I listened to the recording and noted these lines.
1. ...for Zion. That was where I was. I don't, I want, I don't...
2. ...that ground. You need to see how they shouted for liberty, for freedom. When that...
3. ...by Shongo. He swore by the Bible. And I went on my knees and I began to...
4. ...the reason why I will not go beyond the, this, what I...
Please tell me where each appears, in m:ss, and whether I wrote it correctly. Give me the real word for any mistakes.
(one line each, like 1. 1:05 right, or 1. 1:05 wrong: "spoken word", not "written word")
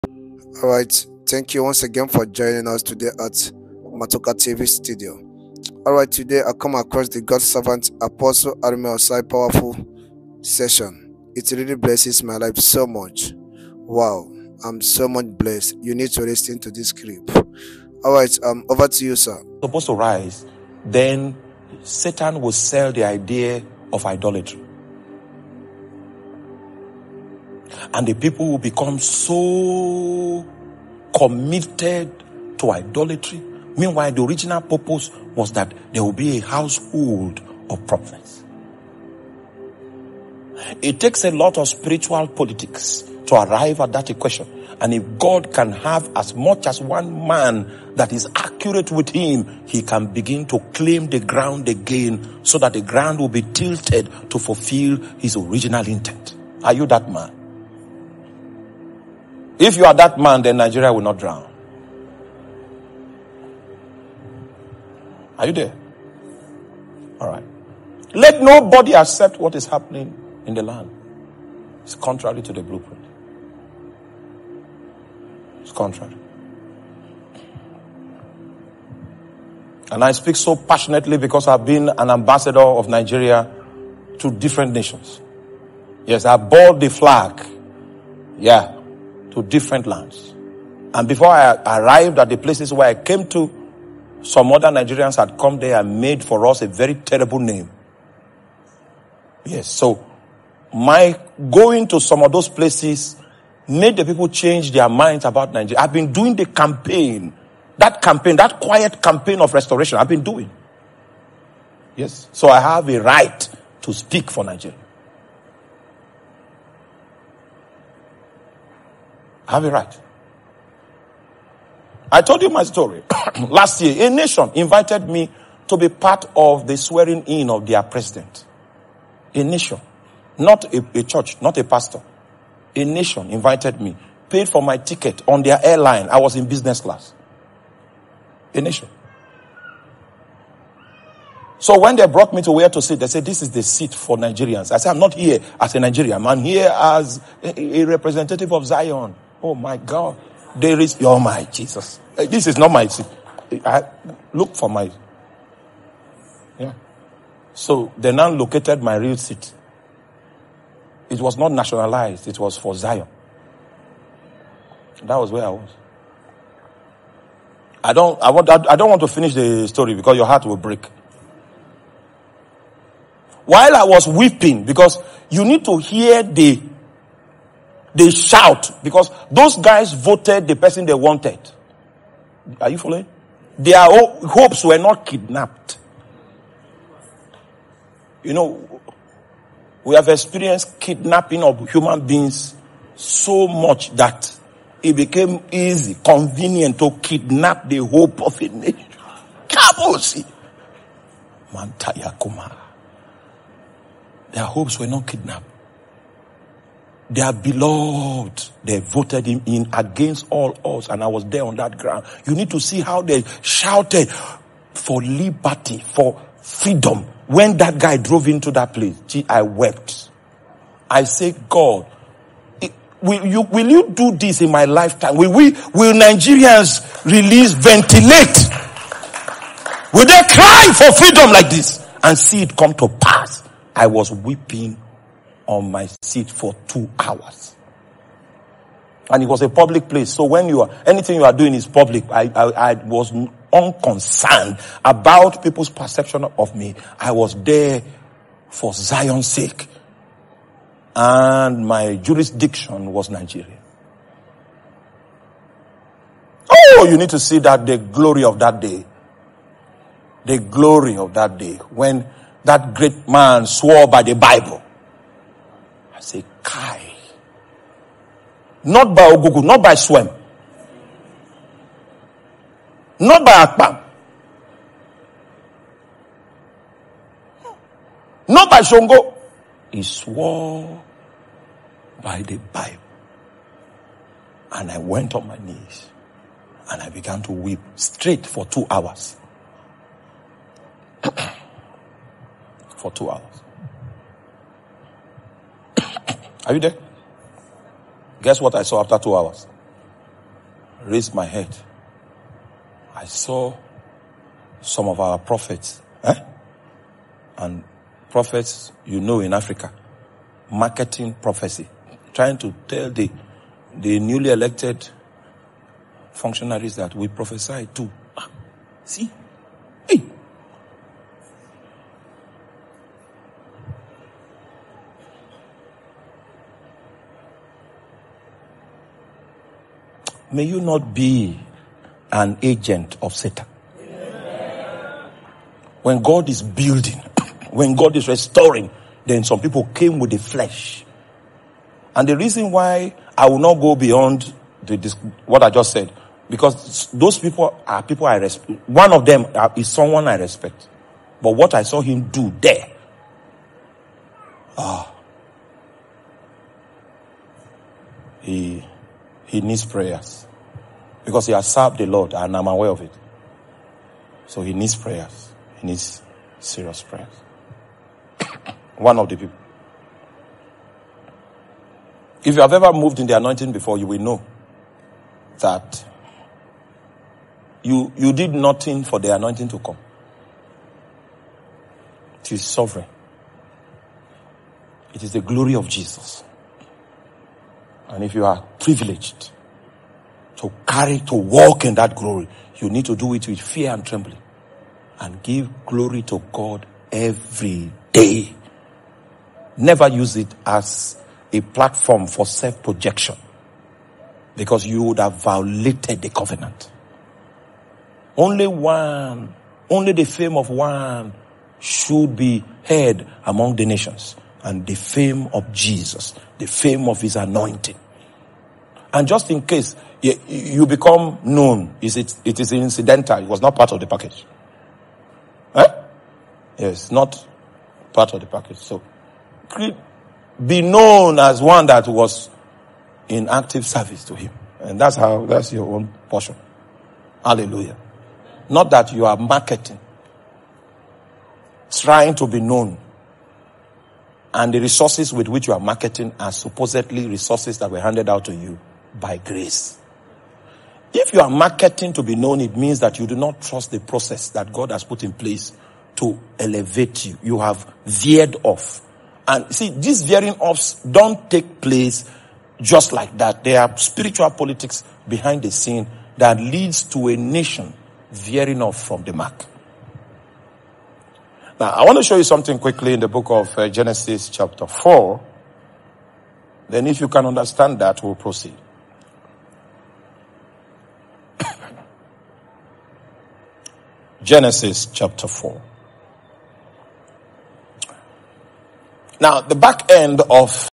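1. 2:42 right
2. 3:31 right
3. 4:38 right
4. 5:42 right.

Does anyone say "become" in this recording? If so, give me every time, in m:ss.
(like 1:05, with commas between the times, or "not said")
0:28, 7:00.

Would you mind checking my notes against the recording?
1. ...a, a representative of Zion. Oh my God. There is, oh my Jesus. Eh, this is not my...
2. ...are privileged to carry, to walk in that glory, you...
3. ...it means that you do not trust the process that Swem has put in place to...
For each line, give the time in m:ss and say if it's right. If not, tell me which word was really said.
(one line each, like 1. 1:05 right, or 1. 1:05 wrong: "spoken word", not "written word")
1. 2:27 right
2. 6:28 right
3. 7:32 wrong: "God", not "Swem".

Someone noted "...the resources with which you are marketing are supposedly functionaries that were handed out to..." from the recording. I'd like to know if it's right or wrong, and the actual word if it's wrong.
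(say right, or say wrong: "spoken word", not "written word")
wrong: "resources", not "functionaries".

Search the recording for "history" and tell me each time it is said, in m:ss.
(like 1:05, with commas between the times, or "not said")
not said.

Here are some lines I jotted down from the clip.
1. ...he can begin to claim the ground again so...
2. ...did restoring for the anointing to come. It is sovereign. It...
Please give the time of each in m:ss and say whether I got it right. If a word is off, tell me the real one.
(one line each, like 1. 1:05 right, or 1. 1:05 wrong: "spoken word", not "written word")
1. 0:49 right
2. 6:18 wrong: "nothing", not "restoring".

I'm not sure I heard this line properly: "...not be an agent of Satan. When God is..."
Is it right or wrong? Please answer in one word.
right.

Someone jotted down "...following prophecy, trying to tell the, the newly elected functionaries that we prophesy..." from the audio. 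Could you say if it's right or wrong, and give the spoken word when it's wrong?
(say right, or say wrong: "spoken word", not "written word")
wrong: "marketing", not "following".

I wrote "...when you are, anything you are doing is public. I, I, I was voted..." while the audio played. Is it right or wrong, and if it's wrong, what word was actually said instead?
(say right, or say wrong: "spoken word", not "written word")
wrong: "unconcerned", not "voted".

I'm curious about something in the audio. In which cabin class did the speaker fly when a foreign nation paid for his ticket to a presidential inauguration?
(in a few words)
business class.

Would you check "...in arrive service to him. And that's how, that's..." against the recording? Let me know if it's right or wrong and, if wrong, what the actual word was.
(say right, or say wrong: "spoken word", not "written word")
wrong: "active", not "arrive".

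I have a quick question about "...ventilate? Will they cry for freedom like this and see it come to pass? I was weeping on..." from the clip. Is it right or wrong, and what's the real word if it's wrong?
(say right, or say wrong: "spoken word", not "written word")
right.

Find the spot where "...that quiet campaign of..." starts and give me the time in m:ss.
1:48.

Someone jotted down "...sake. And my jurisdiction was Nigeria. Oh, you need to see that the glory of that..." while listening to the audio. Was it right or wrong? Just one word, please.
right.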